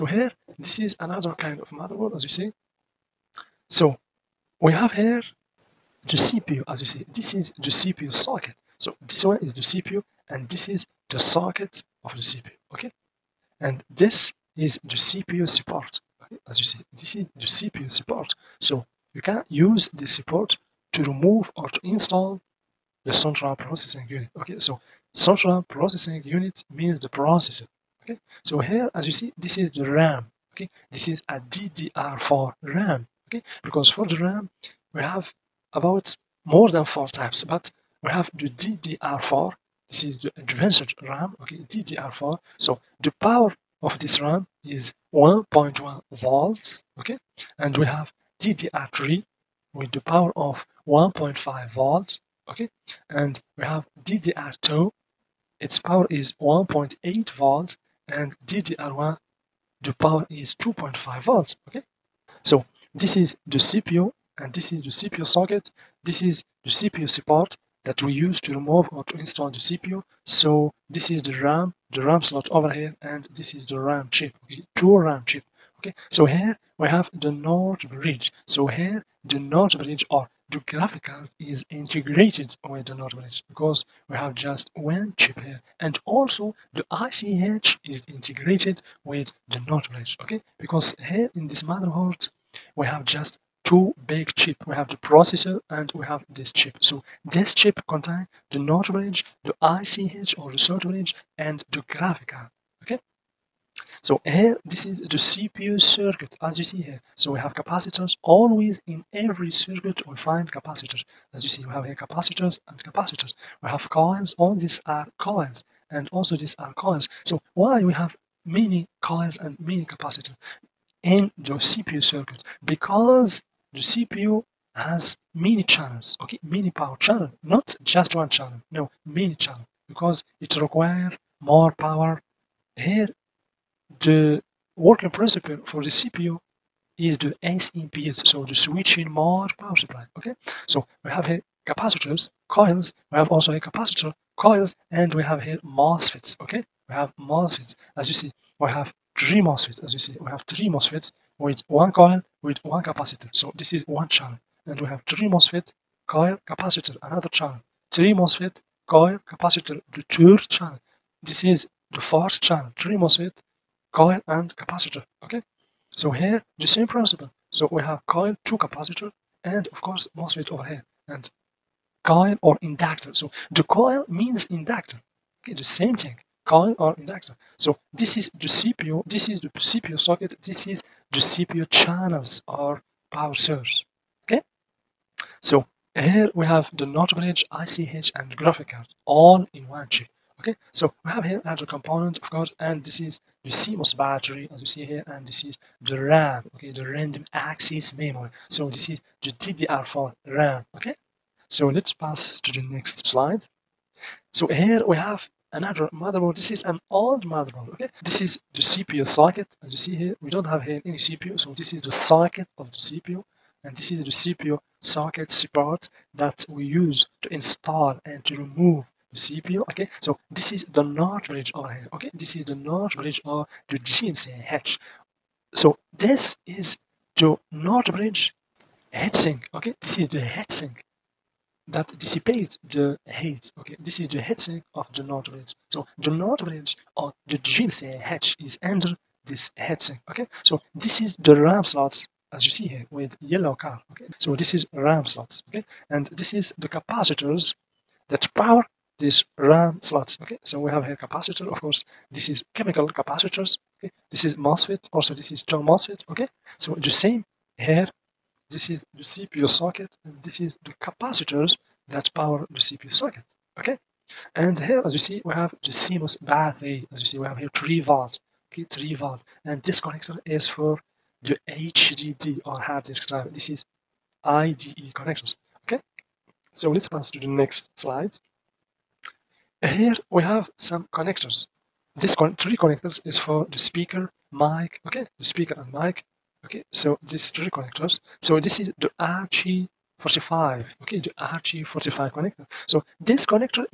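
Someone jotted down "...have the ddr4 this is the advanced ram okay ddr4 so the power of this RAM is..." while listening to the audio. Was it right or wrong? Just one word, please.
right.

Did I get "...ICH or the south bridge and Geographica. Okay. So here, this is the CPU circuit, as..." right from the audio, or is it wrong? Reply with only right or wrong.
right.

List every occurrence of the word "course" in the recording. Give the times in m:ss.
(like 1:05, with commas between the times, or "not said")
2:49, 3:12, 4:11.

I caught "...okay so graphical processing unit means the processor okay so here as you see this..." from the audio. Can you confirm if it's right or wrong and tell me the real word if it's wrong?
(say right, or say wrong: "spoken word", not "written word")
wrong: "central", not "graphical".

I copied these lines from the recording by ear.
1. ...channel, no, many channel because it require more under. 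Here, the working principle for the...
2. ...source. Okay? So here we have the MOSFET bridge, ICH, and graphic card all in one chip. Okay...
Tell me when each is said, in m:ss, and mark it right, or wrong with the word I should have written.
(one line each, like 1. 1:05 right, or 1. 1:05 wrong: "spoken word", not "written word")
1. 2:08 wrong: "power", not "under"
2. 3:03 wrong: "North", not "MOSFET".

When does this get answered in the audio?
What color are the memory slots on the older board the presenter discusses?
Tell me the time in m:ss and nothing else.
4:03.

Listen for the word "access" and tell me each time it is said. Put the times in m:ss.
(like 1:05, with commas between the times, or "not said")
3:17.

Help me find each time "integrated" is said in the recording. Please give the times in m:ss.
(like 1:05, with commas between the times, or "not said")
1:21, 1:28.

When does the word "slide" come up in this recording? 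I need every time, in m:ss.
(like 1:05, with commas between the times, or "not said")
3:23, 4:37.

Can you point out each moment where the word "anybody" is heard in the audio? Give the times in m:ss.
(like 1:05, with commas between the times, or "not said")
not said.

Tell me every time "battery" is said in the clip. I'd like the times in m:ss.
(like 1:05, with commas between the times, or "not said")
3:13, 4:26.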